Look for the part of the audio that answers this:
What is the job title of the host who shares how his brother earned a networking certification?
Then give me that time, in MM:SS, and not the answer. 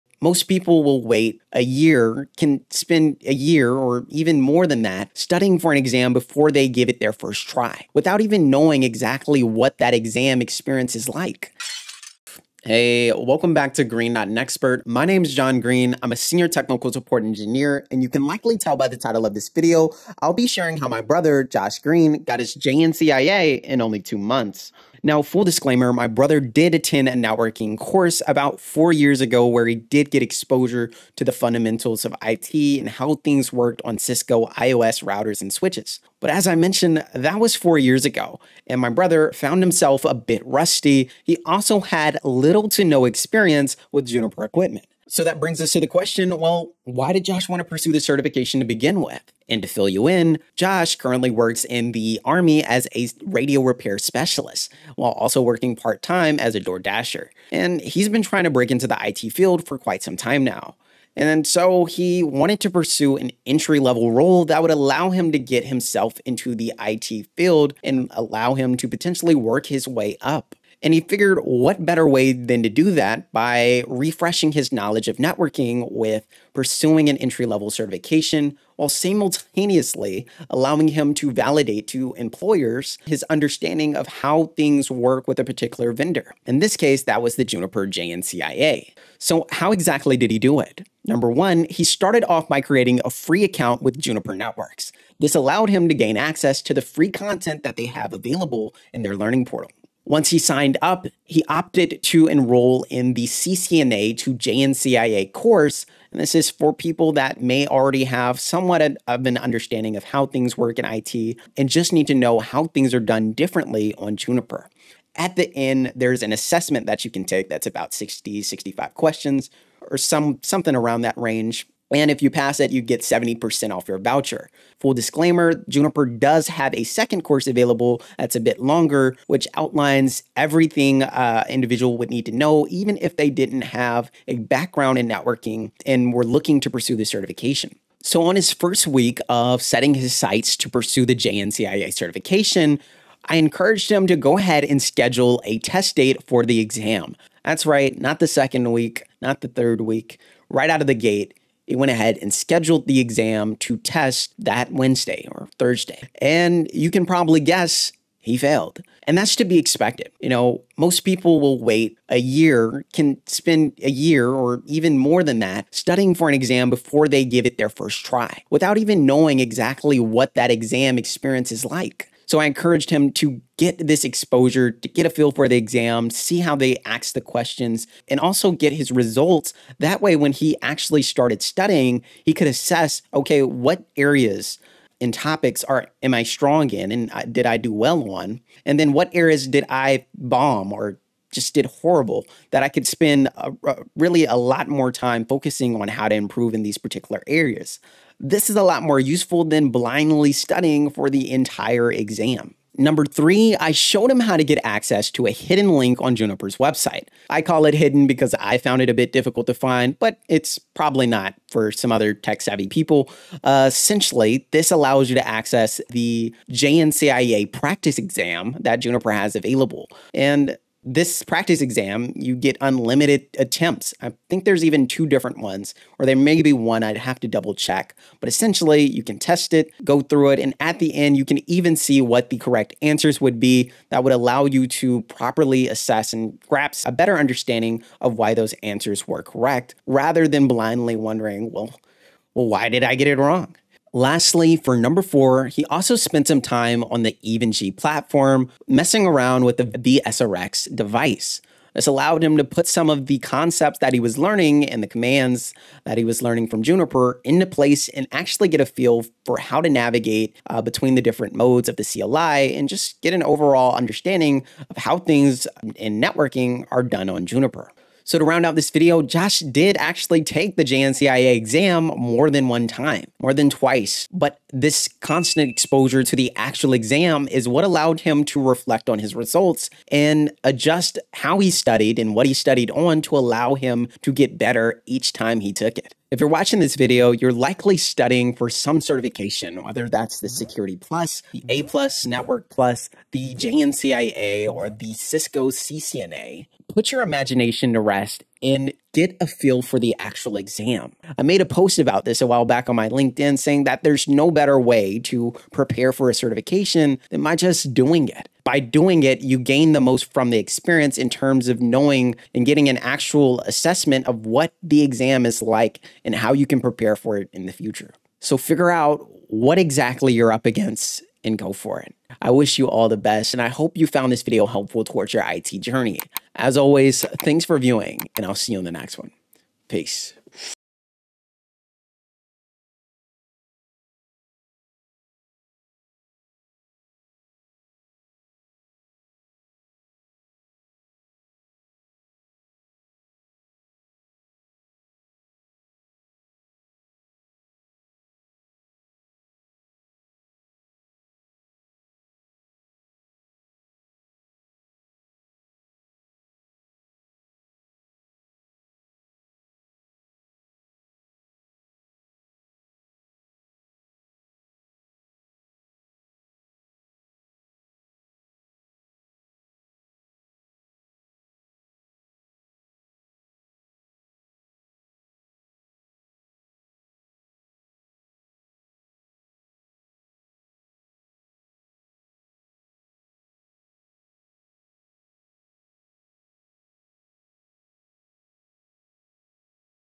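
00:16.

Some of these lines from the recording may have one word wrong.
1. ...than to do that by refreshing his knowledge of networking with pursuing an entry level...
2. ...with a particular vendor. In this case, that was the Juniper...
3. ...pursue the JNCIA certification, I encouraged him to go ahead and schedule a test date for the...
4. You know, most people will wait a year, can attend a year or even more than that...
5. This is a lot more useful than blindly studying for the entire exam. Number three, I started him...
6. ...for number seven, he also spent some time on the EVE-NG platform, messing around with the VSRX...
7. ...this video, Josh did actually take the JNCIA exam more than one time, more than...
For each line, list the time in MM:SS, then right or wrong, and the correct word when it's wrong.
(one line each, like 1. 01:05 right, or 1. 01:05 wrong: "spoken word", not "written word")
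1. 01:12 right
2. 01:25 right
3. 02:20 right
4. 02:40 wrong: "spend", not "attend"
5. 03:18 wrong: "showed", not "started"
6. 04:04 wrong: "four", not "seven"
7. 04:28 right.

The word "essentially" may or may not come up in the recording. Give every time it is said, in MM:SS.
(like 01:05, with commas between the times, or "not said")
03:33, 03:48.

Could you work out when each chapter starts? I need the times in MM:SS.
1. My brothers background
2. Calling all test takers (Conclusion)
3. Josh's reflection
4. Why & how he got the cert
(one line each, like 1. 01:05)
1. 00:24
2. 04:27
3. 05:30
4. 00:44.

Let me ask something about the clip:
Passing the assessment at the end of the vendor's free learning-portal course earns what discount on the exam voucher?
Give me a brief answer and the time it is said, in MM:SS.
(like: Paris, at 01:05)
70%, at 02:03.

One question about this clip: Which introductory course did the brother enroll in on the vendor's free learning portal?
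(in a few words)
CCNA to JNCIA.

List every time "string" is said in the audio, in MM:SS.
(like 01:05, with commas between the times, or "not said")
not said.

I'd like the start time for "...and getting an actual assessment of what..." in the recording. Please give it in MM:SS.
05:12.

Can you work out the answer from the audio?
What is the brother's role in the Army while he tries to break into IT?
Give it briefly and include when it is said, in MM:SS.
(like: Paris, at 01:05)
Radio repair specialist, at 00:53.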